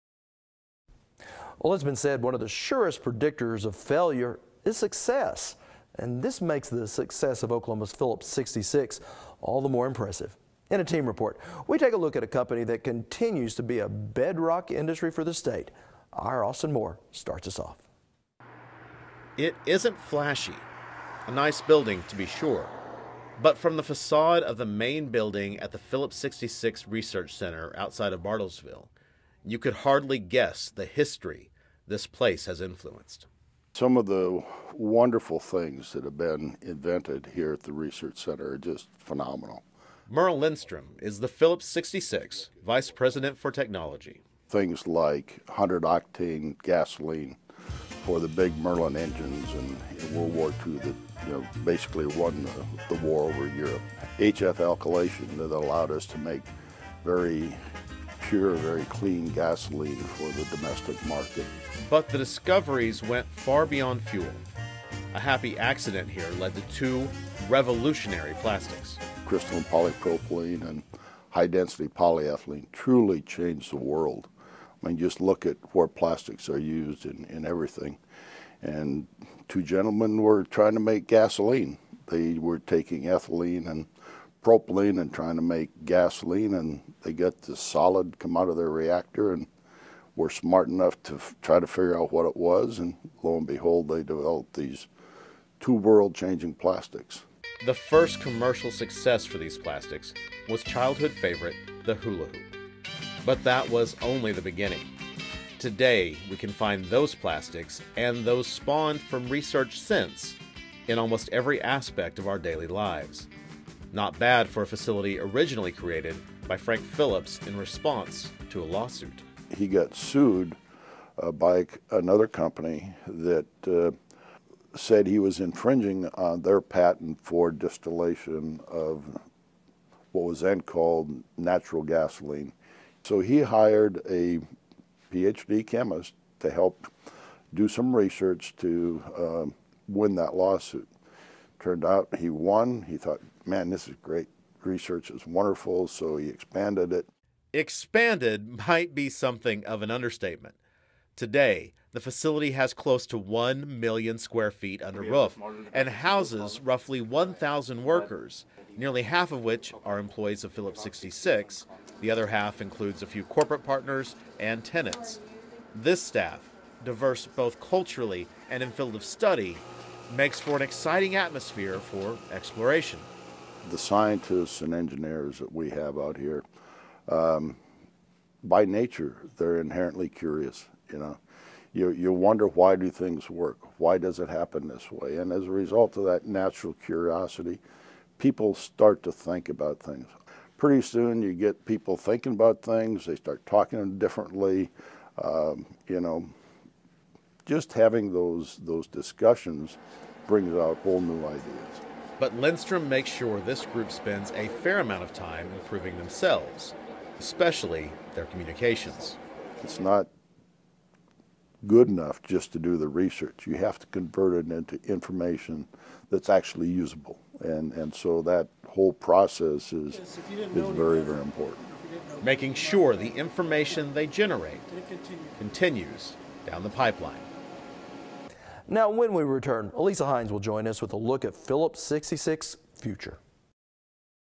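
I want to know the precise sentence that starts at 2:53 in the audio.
The scientists and engineers that we have out here, um, by nature, they're inherently curious.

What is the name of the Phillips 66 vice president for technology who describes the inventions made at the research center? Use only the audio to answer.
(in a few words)
Merl Lindstrom.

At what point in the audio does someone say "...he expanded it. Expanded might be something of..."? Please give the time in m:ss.
2:26.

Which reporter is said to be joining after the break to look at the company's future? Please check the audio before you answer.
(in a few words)
Elisa Hines.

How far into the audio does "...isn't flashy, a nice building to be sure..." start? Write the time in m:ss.
0:19.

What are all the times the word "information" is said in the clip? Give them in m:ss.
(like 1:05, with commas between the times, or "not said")
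3:34, 3:43.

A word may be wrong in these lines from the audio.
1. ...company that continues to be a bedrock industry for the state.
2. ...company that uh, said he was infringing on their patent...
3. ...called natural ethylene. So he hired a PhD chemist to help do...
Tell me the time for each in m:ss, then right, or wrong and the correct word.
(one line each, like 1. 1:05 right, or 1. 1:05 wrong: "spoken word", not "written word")
1. 0:12 right
2. 2:02 right
3. 2:10 wrong: "gasoline", not "ethylene".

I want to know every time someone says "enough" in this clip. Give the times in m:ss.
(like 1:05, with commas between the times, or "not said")
1:30, 3:31.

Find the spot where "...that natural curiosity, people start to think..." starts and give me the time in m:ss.
3:06.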